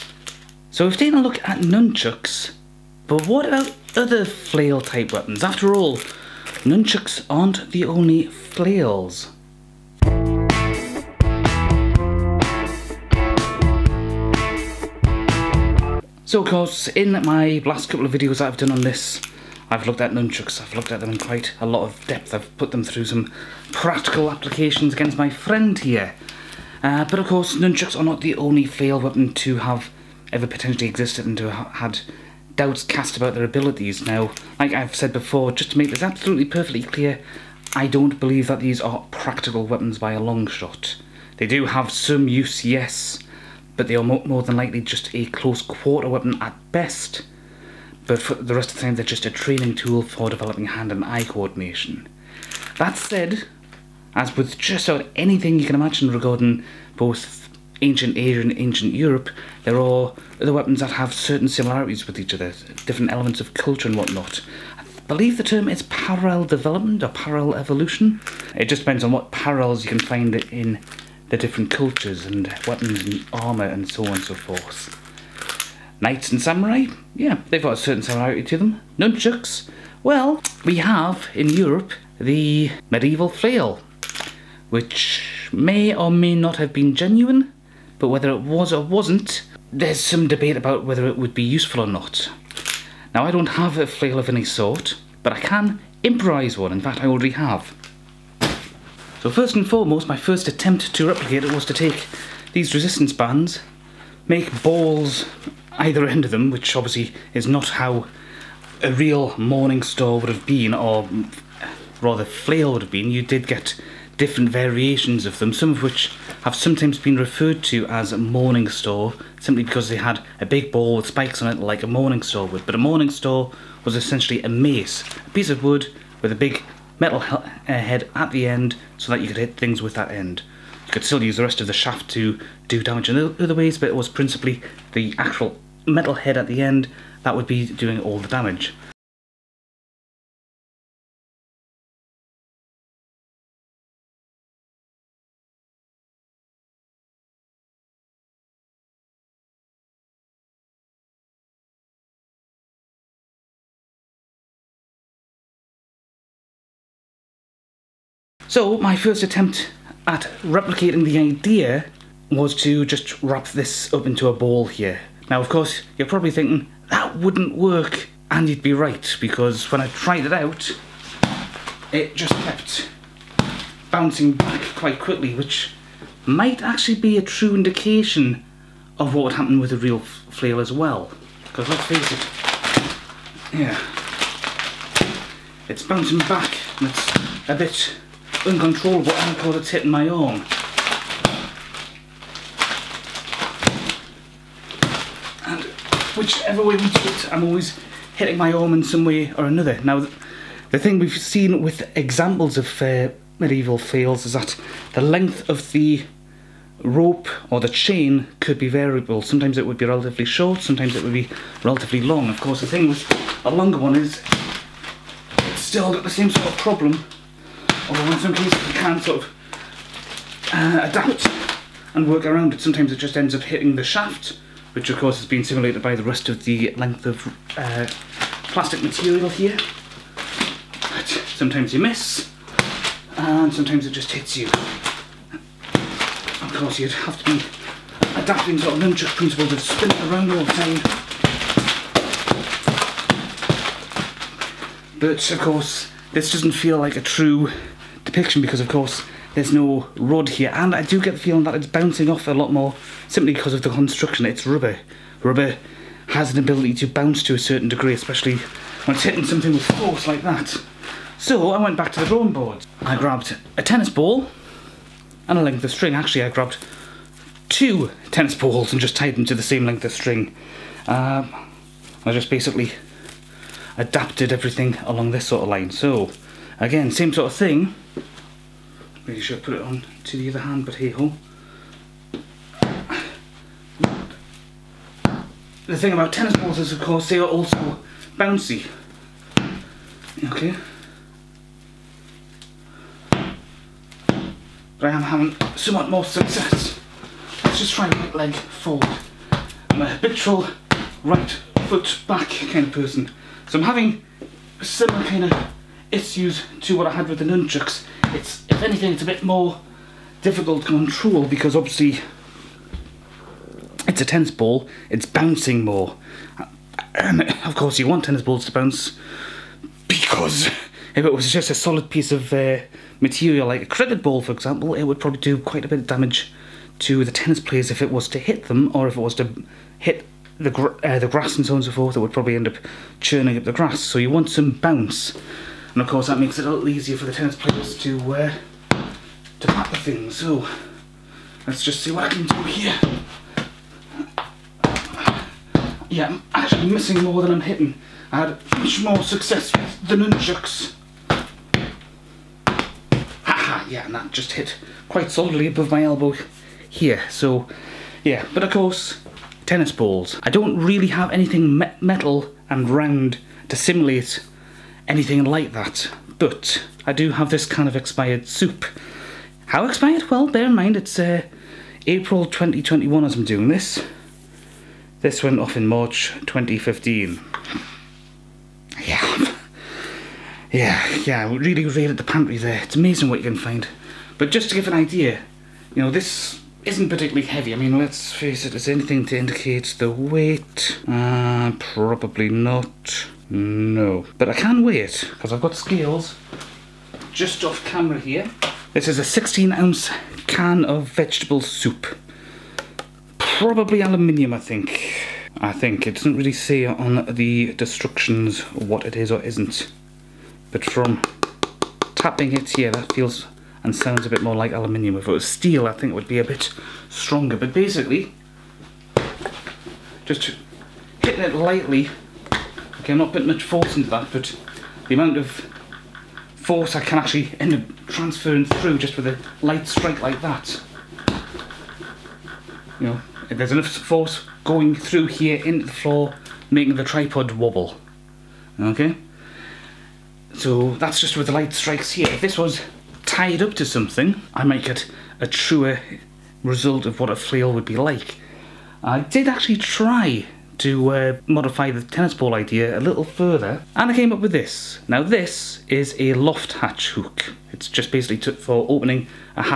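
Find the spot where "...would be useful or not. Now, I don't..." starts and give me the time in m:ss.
1:31.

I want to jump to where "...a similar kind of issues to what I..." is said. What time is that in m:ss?
5:04.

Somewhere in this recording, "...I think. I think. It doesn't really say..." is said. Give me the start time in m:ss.
6:44.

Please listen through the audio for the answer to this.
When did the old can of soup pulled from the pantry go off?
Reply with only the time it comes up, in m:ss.
6:15.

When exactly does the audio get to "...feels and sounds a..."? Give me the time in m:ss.
6:52.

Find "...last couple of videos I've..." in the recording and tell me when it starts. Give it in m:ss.
0:17.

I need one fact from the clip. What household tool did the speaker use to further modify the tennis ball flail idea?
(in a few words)
a loft hatch hook.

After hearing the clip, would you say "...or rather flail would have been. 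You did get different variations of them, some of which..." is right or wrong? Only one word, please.
right.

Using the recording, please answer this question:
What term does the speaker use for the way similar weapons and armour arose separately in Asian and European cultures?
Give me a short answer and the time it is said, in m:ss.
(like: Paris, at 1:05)
parallel development, at 1:05.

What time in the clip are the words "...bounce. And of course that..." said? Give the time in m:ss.
5:34.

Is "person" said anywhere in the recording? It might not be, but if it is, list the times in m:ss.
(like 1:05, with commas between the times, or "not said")
5:02.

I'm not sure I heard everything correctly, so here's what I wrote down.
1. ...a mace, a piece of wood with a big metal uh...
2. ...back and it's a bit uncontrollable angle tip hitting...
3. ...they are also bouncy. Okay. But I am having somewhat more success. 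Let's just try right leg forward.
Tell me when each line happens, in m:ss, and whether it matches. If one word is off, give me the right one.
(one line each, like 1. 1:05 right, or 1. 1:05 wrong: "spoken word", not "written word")
1. 2:04 right
2. 3:06 right
3. 4:47 right.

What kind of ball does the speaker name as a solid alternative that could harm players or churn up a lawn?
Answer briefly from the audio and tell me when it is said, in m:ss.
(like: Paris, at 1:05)
a cricket ball, at 5:23.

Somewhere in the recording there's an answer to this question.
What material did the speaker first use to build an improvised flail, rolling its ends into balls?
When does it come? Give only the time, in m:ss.
1:42.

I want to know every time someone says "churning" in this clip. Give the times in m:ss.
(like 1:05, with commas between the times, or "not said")
5:32.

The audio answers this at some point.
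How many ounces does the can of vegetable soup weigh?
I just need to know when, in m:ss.
6:39.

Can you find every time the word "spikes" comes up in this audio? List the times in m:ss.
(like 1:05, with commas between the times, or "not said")
2:01.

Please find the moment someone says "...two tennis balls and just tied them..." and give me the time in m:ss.
4:27.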